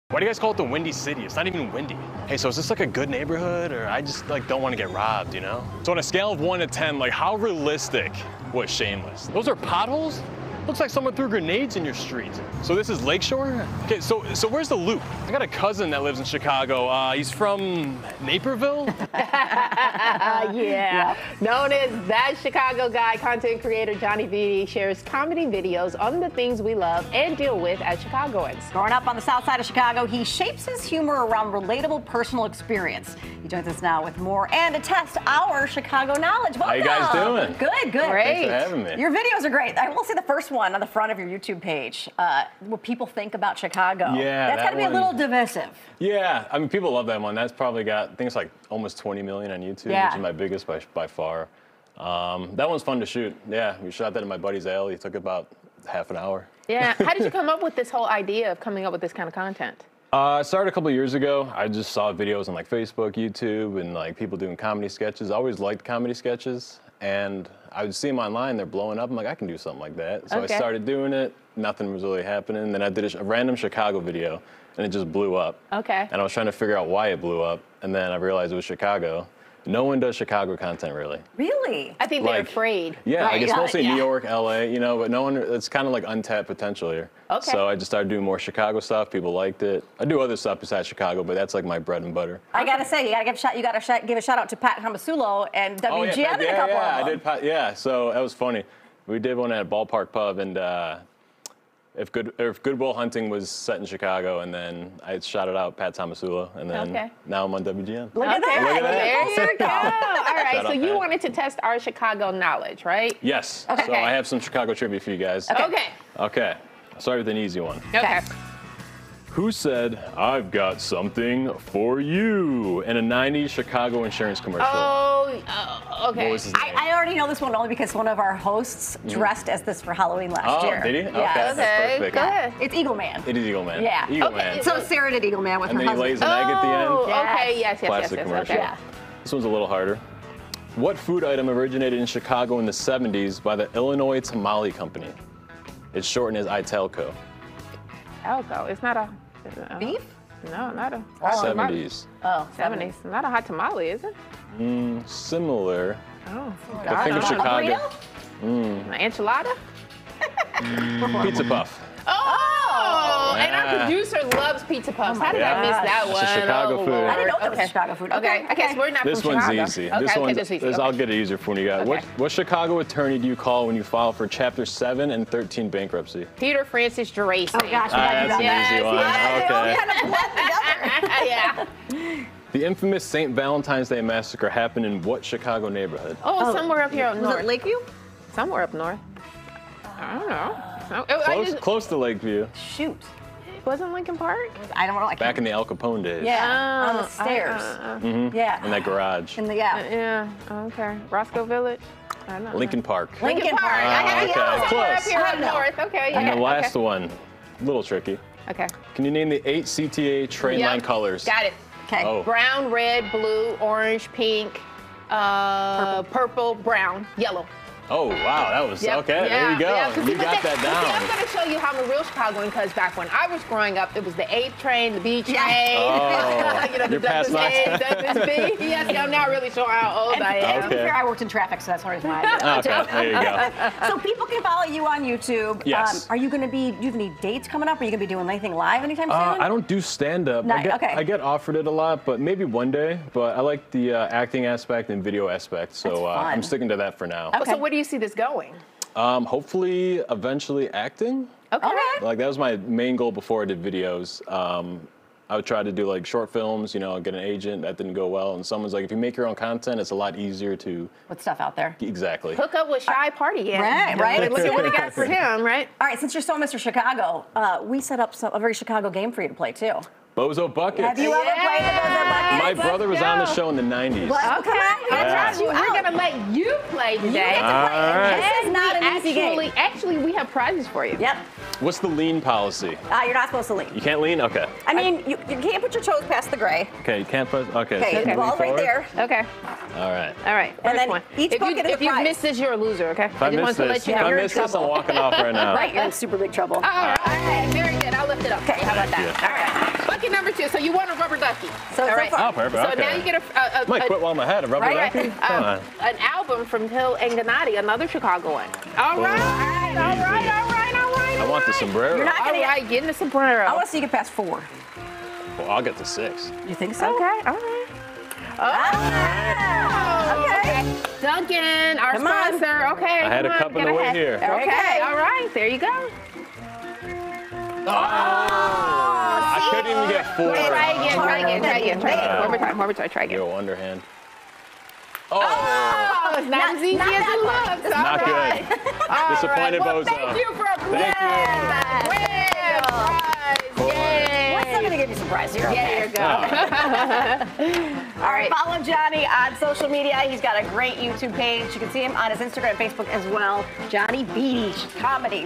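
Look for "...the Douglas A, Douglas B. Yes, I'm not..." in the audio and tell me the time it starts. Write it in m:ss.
3:46.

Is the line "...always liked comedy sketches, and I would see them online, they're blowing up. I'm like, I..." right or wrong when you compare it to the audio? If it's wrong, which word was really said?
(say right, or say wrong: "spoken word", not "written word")
right.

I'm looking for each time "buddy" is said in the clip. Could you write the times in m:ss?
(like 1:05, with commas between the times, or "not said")
0:54.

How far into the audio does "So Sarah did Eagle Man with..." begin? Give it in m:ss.
2:14.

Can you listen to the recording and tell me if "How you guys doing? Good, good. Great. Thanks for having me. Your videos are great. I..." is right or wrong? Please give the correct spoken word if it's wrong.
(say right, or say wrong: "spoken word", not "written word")
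right.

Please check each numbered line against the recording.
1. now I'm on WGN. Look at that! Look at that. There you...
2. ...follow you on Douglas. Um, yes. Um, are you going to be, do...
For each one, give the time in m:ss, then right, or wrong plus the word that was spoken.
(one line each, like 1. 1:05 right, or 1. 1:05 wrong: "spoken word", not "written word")
1. 1:47 right
2. 3:54 wrong: "YouTube", not "Douglas".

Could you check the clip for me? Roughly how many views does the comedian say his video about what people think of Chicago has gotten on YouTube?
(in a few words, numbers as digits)
almost 20 million.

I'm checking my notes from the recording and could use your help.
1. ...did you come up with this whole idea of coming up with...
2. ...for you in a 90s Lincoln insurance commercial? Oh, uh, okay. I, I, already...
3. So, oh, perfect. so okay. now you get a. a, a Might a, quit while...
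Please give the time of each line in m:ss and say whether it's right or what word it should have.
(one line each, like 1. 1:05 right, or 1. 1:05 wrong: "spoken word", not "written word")
1. 0:57 right
2. 2:01 wrong: "Chicago", not "Lincoln"
3. 5:02 right.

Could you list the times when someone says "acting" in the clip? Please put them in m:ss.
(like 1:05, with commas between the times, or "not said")
4:04, 4:10.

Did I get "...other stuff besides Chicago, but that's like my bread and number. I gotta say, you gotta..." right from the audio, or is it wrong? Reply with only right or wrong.
wrong.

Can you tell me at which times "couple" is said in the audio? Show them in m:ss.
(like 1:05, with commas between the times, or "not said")
1:00, 1:36.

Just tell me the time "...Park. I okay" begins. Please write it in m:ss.
3:23.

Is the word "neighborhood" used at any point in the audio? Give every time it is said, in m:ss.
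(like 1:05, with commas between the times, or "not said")
0:03, 3:05.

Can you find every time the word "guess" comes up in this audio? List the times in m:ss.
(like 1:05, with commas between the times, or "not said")
1:23, 2:48.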